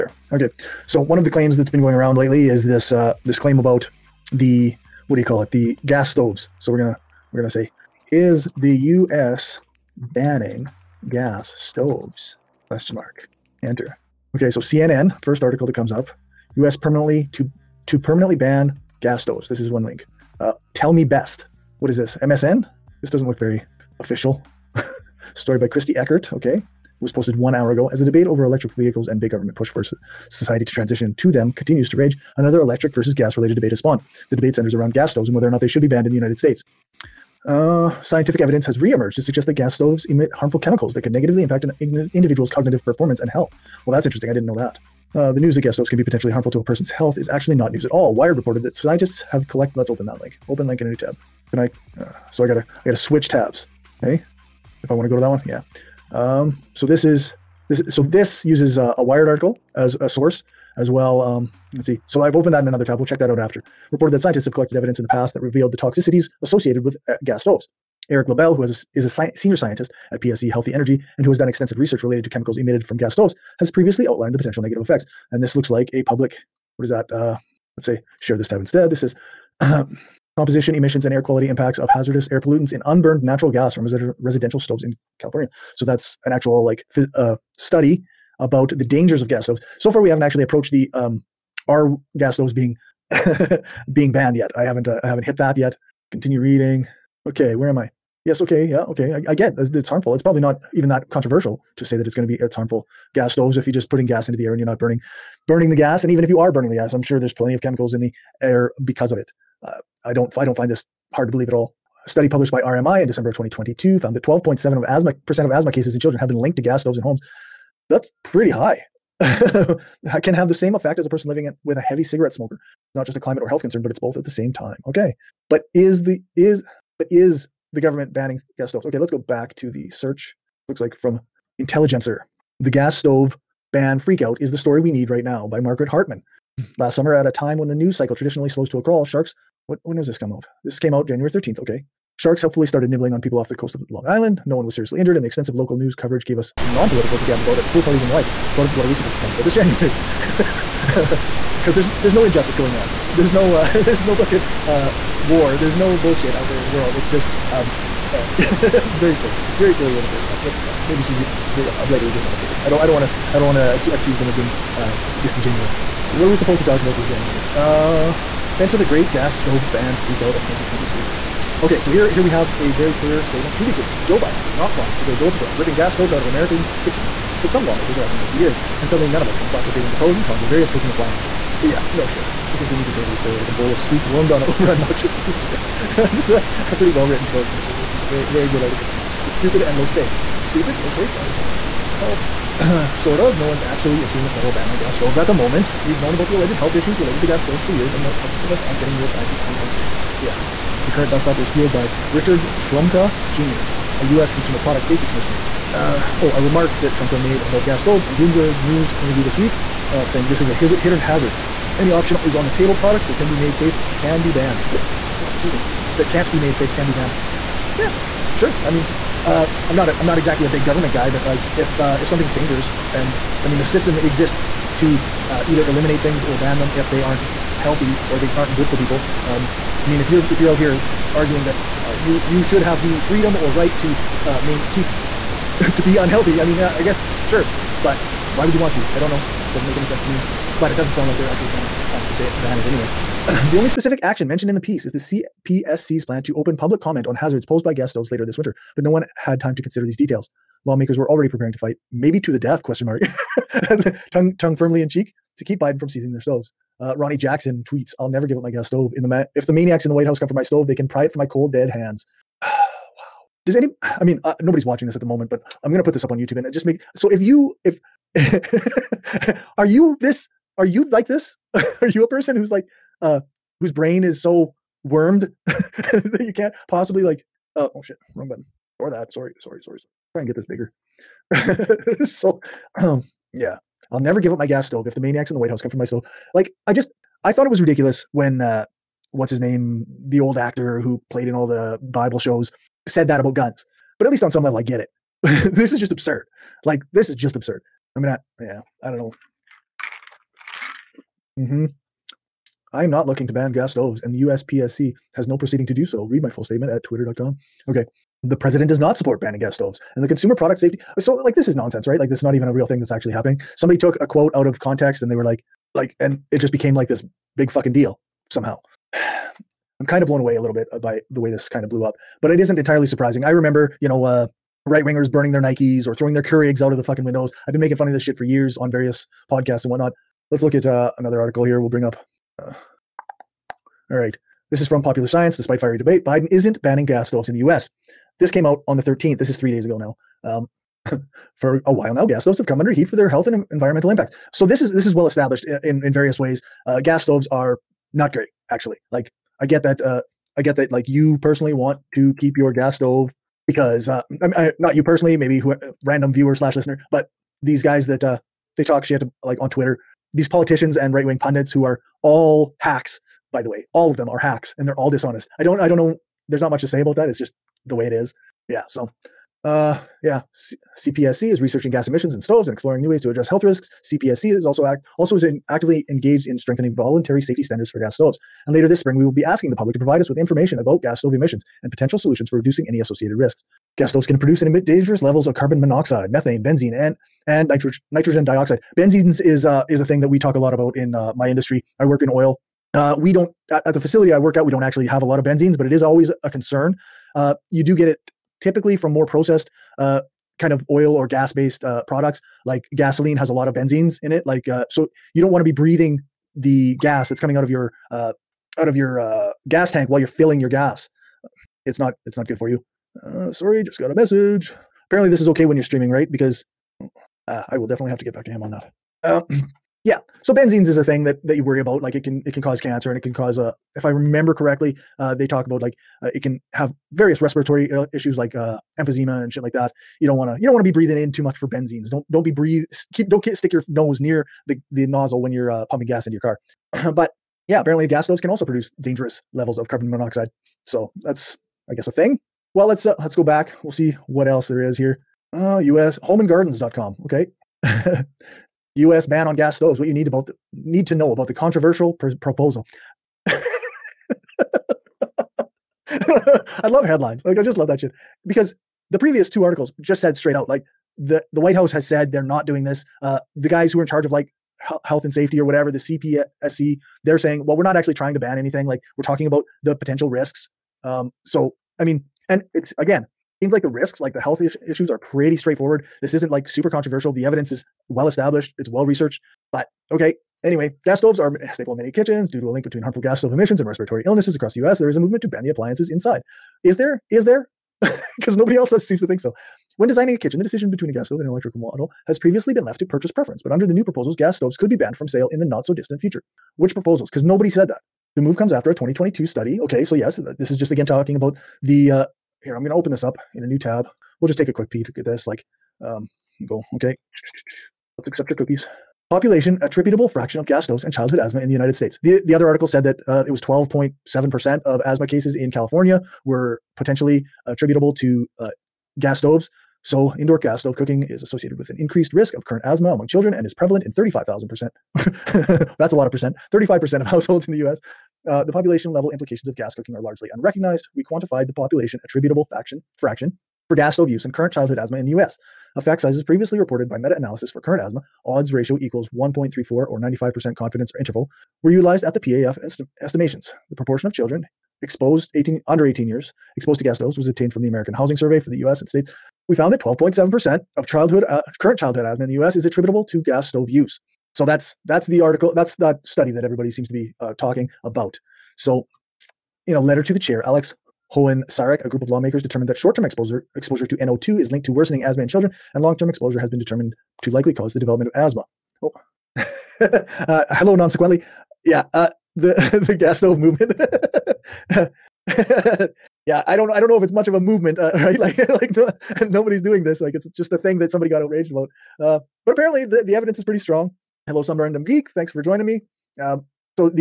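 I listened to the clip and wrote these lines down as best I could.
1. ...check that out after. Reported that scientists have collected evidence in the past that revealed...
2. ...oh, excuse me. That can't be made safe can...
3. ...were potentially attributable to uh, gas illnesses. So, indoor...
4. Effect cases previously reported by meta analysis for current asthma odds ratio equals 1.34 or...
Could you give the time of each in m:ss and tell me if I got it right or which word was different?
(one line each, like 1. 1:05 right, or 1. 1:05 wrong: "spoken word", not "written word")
1. 1:03 right
2. 3:34 right
3. 8:36 wrong: "stoves", not "illnesses"
4. 8:55 wrong: "sizes", not "cases".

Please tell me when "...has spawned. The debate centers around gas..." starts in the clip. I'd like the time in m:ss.
0:33.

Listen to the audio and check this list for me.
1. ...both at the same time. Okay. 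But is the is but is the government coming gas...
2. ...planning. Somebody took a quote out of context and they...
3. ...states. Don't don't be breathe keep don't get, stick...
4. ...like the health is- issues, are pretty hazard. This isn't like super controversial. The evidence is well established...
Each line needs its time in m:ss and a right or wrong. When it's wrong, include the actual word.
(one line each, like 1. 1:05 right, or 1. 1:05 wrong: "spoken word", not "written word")
1. 2:03 wrong: "banning", not "coming"
2. 5:13 wrong: "happening", not "planning"
3. 7:11 wrong: "benzenes", not "states"
4. 7:53 wrong: "straightforward", not "hazard".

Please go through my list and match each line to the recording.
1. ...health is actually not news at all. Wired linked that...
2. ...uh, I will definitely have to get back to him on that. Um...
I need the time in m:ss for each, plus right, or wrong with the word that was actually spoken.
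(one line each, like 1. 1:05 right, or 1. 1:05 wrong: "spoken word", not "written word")
1. 0:46 wrong: "reported", not "linked"
2. 6:57 right.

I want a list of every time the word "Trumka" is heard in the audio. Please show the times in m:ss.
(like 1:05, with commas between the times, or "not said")
3:22, 3:26.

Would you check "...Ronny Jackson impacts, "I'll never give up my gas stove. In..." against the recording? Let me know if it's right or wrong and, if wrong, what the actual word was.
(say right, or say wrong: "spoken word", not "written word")
wrong: "tweets", not "impacts".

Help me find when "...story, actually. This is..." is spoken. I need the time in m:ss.
3:07.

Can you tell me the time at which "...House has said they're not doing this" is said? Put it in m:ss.
7:41.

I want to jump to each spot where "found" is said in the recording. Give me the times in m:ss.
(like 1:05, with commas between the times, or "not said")
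1:53, 9:09.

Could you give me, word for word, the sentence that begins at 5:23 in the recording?
I remember, you know, uh, right wingers burning their Nikes or throwing their eggs out of the fucking windows.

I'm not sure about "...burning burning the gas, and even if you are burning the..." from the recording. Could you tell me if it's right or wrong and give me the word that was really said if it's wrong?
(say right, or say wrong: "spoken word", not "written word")
right.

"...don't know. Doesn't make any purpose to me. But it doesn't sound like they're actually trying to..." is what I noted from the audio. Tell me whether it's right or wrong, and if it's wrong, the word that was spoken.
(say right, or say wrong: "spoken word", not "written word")
wrong: "sense", not "purpose".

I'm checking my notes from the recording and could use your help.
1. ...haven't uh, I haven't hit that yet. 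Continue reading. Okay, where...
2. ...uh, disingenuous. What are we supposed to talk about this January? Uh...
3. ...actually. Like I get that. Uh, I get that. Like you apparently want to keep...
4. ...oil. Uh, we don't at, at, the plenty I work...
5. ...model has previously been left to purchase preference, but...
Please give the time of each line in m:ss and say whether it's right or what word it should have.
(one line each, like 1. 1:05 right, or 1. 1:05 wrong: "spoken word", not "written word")
1. 1:34 right
2. 2:44 right
3. 5:48 wrong: "personally", not "apparently"
4. 6:32 wrong: "facility", not "plenty"
5. 8:11 right.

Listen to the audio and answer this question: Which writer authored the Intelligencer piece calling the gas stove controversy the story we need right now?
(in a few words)
Margaret Hartmann.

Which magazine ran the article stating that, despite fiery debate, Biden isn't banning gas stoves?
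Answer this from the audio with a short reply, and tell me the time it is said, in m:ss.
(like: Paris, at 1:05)
Popular Science, at 5:34.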